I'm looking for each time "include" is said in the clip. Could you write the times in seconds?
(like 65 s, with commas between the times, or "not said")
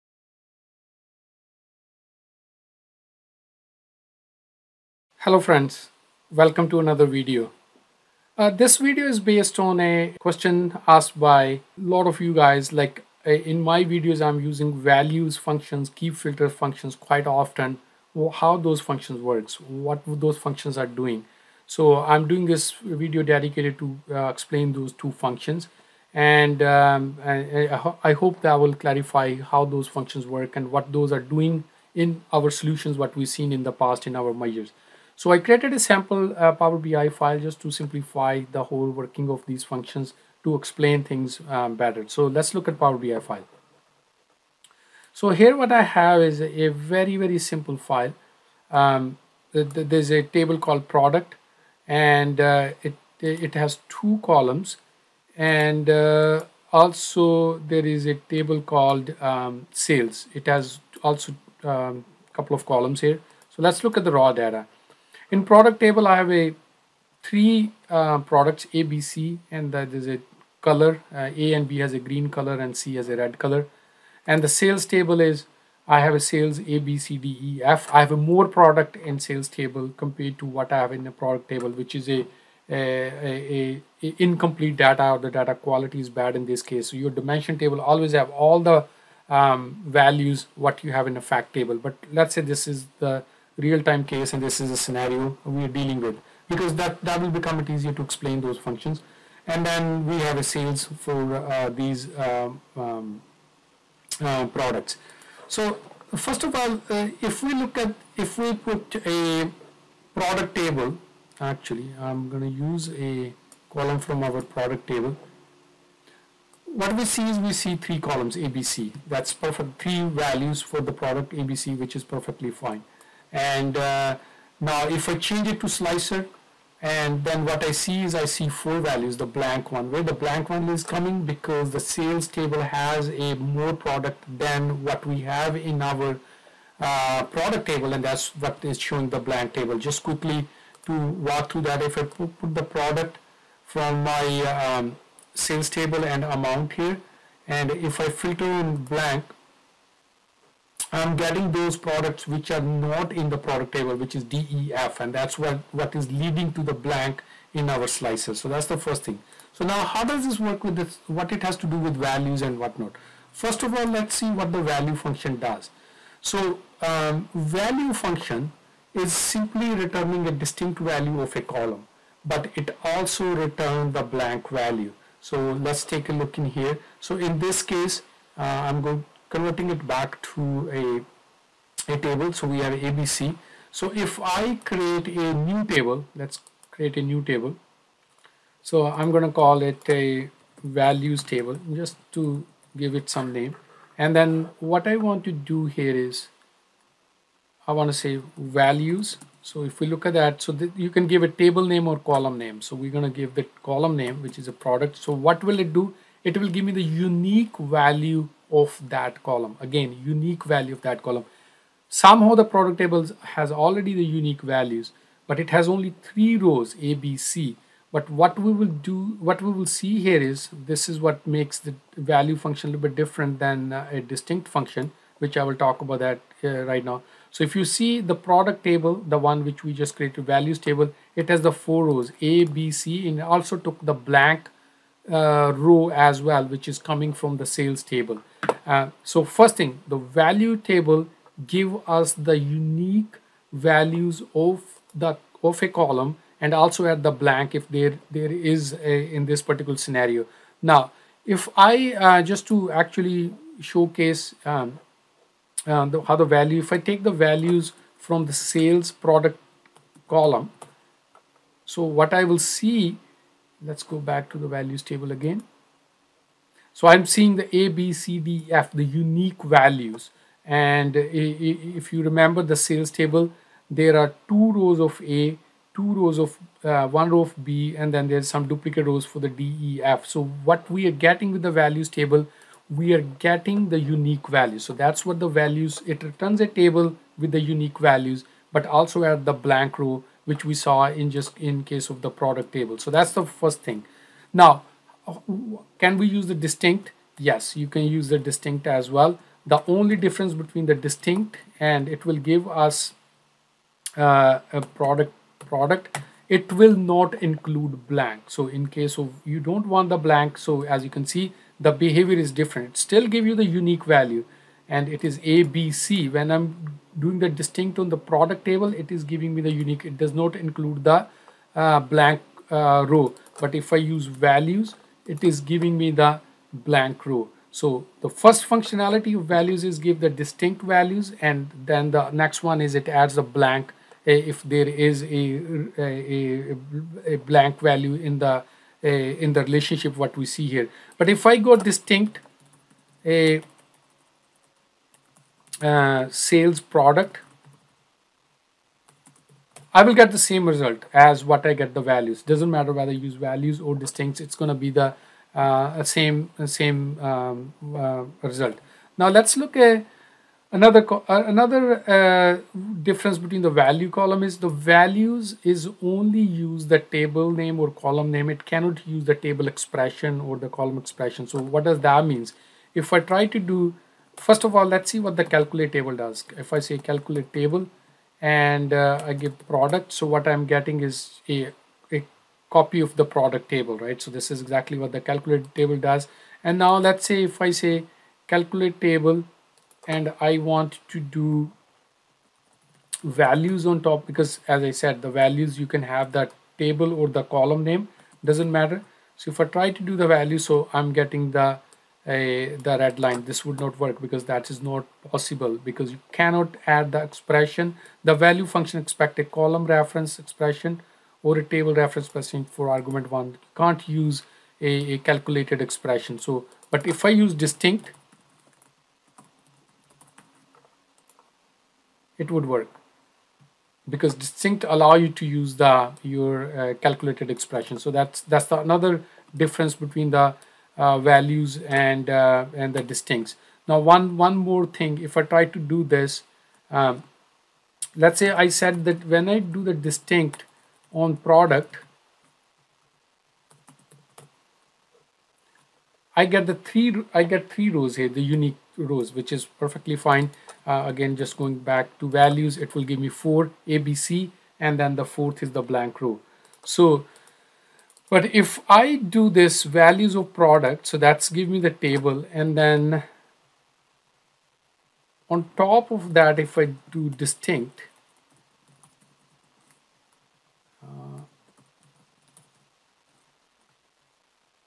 307 s, 320 s.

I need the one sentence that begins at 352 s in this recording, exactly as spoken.
Doesn't matter whether you use values or distincts, it's going to be the uh, same same um, uh, result.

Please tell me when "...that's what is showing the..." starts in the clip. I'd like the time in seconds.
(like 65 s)
138 s.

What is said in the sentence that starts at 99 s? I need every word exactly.
And then we have a sales for uh, these um, um uh, products.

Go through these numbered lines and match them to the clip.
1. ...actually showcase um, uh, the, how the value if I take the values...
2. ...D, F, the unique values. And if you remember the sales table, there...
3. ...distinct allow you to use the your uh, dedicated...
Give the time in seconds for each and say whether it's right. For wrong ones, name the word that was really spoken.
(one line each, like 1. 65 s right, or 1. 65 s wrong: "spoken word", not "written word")
1. 252 s right
2. 268 s right
3. 424 s wrong: "calculated", not "dedicated".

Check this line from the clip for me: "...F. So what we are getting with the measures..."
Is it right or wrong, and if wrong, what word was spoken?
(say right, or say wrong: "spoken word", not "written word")
wrong: "values", not "measures".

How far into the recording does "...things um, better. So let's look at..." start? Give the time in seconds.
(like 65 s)
41 s.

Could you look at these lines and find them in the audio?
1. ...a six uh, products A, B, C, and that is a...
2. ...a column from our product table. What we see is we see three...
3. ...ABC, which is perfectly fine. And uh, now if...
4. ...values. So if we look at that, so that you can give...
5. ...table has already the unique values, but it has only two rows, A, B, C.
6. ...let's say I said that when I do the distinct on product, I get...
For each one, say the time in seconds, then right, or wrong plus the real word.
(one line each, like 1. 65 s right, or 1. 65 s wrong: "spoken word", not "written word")
1. 66 s wrong: "three", not "six"
2. 112 s right
3. 121 s right
4. 198 s right
5. 212 s wrong: "three", not "two"
6. 437 s right.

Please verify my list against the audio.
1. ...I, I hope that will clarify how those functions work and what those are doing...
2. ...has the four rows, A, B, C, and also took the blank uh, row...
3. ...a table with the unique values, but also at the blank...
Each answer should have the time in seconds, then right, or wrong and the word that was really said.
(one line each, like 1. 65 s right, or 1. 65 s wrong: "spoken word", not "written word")
1. 27 s right
2. 231 s right
3. 286 s right.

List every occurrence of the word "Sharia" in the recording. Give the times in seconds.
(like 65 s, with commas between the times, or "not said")
not said.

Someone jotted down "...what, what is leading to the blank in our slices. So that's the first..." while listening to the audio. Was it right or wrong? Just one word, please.
right.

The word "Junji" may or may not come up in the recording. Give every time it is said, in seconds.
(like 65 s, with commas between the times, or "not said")
not said.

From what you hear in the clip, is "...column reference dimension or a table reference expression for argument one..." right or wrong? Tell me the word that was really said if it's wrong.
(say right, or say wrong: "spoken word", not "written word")
wrong: "expression", not "dimension".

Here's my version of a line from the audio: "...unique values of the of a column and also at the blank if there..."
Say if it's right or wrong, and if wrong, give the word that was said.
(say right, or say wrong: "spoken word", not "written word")
right.